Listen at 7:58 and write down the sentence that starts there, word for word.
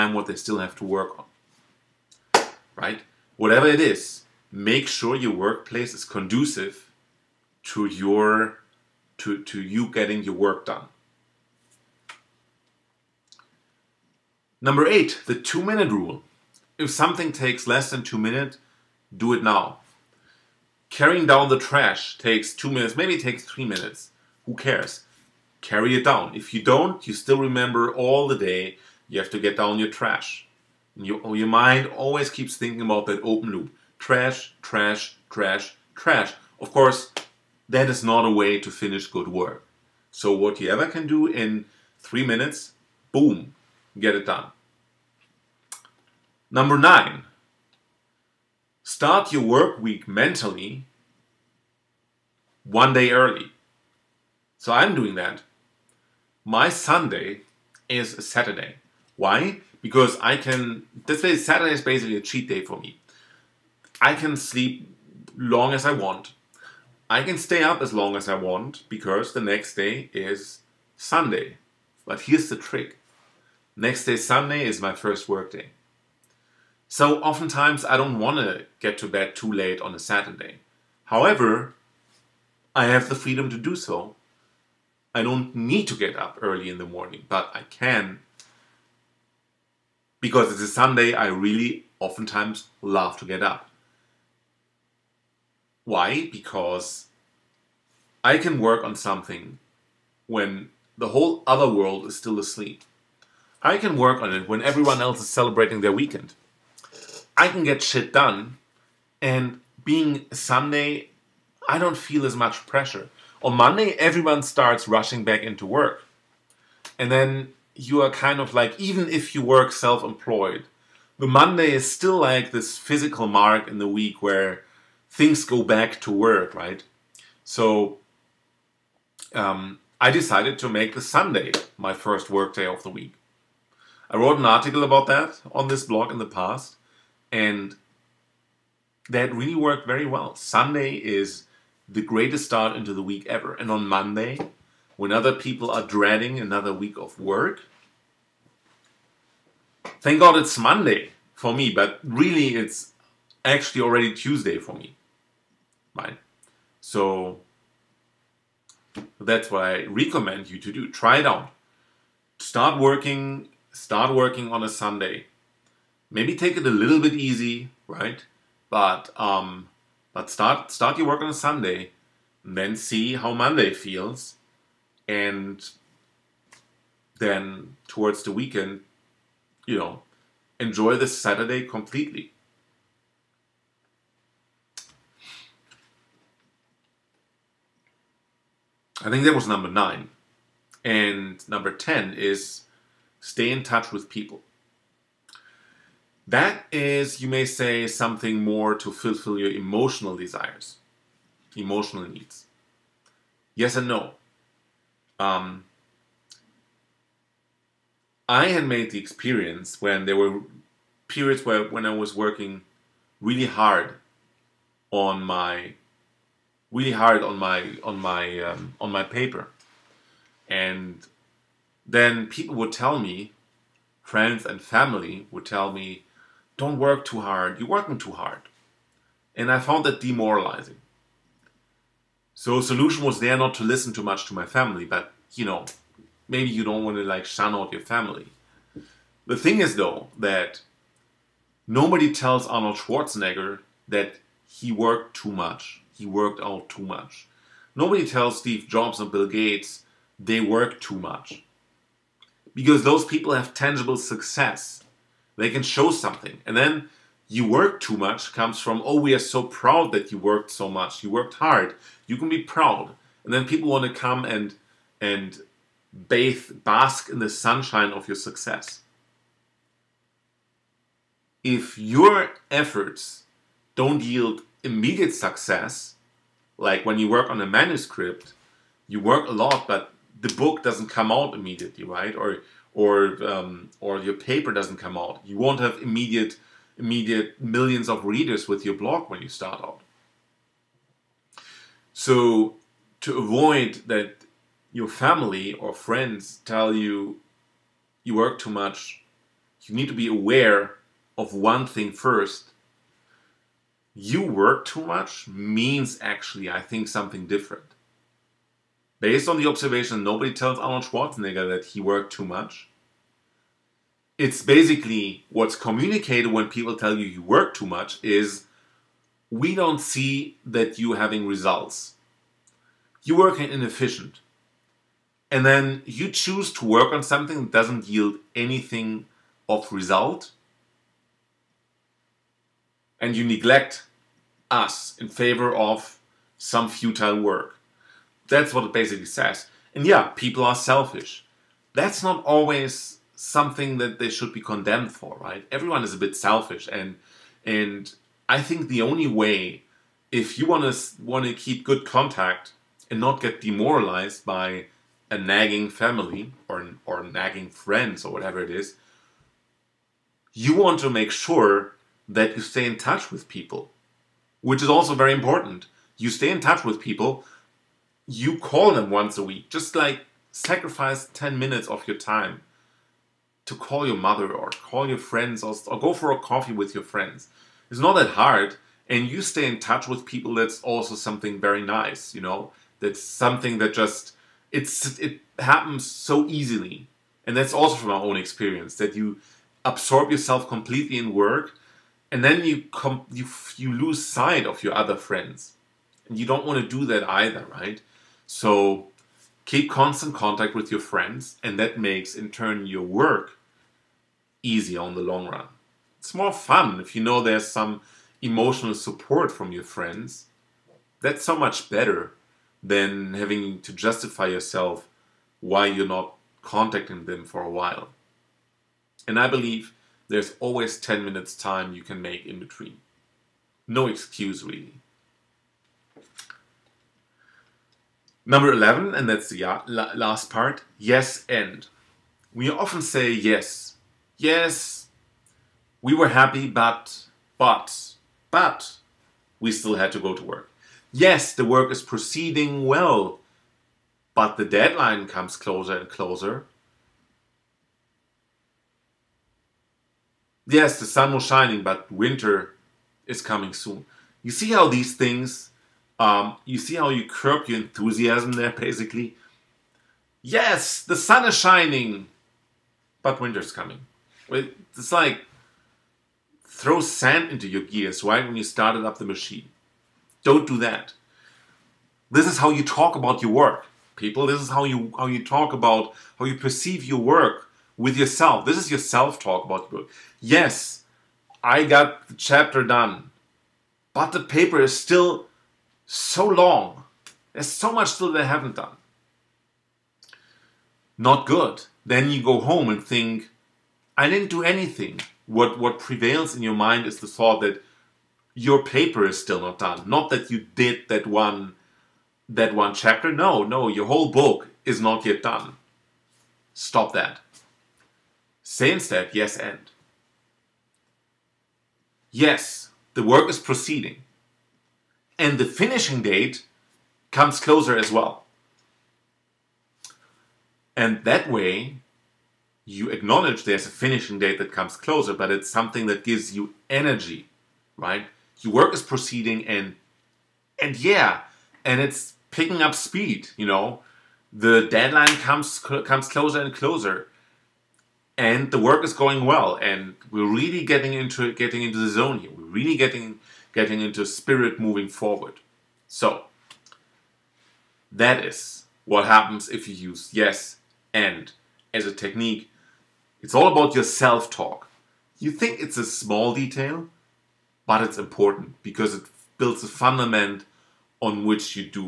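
This is your self-talk about your work.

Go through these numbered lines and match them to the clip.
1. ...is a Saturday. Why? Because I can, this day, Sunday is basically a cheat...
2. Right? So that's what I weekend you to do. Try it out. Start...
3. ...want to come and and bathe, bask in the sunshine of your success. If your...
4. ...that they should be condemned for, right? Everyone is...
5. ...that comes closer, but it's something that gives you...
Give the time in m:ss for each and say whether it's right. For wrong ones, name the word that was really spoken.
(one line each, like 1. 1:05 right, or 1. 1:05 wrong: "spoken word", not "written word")
1. 0:57 wrong: "Saturday", not "Sunday"
2. 2:35 wrong: "recommend", not "weekend"
3. 4:23 right
4. 5:43 right
5. 8:44 right.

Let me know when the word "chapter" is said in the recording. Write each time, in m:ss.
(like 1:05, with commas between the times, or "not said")
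8:02, 8:22.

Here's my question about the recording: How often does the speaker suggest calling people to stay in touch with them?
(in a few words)
once a week.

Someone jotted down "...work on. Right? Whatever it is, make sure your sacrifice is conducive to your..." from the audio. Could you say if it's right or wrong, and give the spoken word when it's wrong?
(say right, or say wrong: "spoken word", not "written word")
wrong: "workplace", not "sacrifice".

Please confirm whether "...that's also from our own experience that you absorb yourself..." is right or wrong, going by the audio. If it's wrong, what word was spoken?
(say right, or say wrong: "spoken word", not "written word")
right.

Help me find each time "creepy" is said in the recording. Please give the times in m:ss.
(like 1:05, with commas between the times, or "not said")
not said.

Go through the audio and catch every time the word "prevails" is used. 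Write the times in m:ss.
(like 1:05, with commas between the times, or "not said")
8:15.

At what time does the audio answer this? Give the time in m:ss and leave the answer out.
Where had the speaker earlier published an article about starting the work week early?
2:15.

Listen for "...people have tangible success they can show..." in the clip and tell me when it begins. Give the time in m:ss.
4:13.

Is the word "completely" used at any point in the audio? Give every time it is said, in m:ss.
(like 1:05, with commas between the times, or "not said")
3:01, 6:30.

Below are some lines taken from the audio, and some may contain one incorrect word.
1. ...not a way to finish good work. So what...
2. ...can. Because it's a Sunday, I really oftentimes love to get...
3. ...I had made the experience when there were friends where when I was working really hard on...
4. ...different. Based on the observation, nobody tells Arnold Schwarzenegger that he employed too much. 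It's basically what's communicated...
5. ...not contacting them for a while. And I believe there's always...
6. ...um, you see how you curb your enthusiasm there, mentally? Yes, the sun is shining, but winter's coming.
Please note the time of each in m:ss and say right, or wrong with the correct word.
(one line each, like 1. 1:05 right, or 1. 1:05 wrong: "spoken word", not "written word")
1. 0:38 right
2. 1:27 right
3. 3:28 wrong: "periods", not "friends"
4. 5:07 wrong: "worked", not "employed"
5. 6:55 right
6. 7:35 wrong: "basically", not "mentally".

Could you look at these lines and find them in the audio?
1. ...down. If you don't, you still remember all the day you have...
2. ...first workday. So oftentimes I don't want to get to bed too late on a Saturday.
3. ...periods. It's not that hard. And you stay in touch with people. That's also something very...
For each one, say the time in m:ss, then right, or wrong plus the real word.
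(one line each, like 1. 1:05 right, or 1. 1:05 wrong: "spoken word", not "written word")
1. 0:26 right
2. 1:14 right
3. 6:16 wrong: "friends", not "periods".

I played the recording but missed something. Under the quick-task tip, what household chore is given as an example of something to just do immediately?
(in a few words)
Carrying down the trash.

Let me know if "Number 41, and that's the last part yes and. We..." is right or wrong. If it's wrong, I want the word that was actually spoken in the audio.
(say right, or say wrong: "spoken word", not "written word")
wrong: "11", not "41".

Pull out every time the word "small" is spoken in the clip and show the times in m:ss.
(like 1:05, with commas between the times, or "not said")
9:15.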